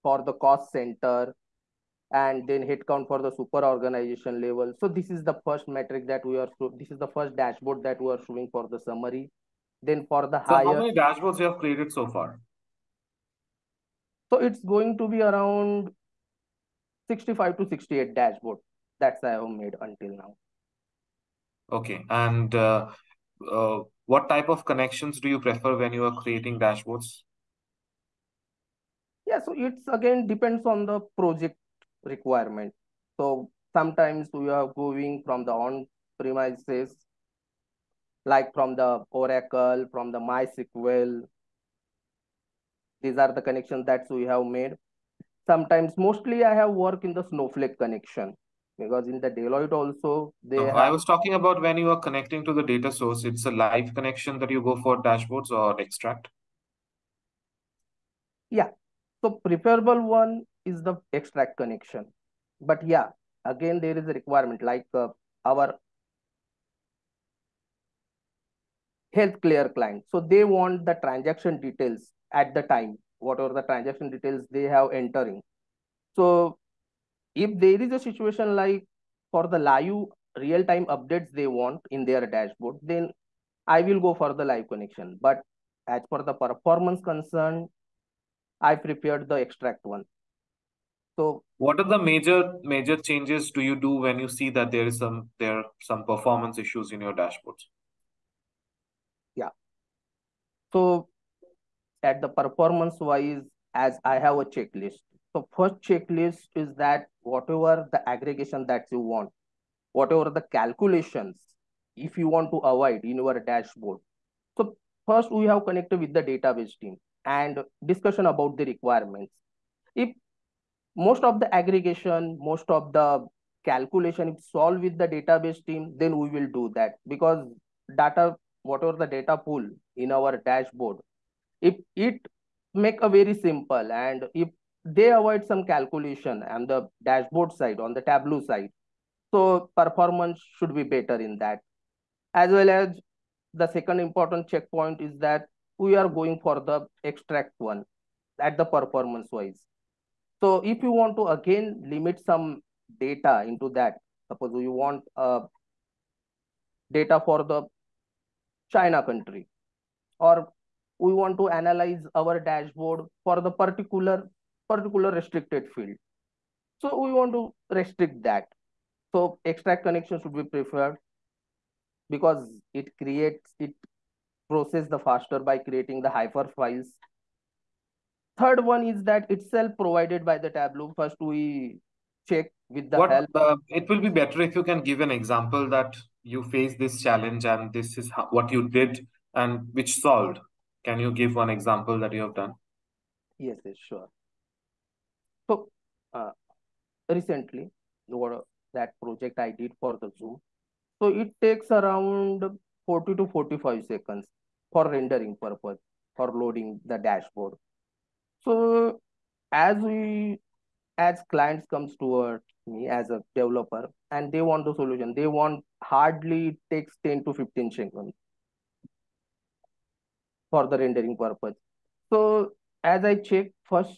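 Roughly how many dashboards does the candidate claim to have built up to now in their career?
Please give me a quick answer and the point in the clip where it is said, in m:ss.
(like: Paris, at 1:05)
65 to 68, at 0:17.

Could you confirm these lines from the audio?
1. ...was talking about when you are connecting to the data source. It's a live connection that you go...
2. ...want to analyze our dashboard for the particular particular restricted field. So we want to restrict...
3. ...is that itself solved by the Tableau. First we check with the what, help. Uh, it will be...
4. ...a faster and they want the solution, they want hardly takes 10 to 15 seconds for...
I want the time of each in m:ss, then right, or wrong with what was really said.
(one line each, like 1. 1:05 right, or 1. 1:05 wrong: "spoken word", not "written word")
1. 0:50 right
2. 2:41 right
3. 2:58 wrong: "provided", not "solved"
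4. 3:33 wrong: "developer", not "faster".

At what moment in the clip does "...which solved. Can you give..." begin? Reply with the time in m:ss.
3:09.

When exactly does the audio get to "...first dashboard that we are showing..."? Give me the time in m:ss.
0:07.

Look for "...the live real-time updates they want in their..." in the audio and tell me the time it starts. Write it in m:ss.
1:19.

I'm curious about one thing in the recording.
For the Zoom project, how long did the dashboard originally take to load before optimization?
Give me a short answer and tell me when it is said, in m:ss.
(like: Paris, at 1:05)
40 to 45 seconds, at 3:22.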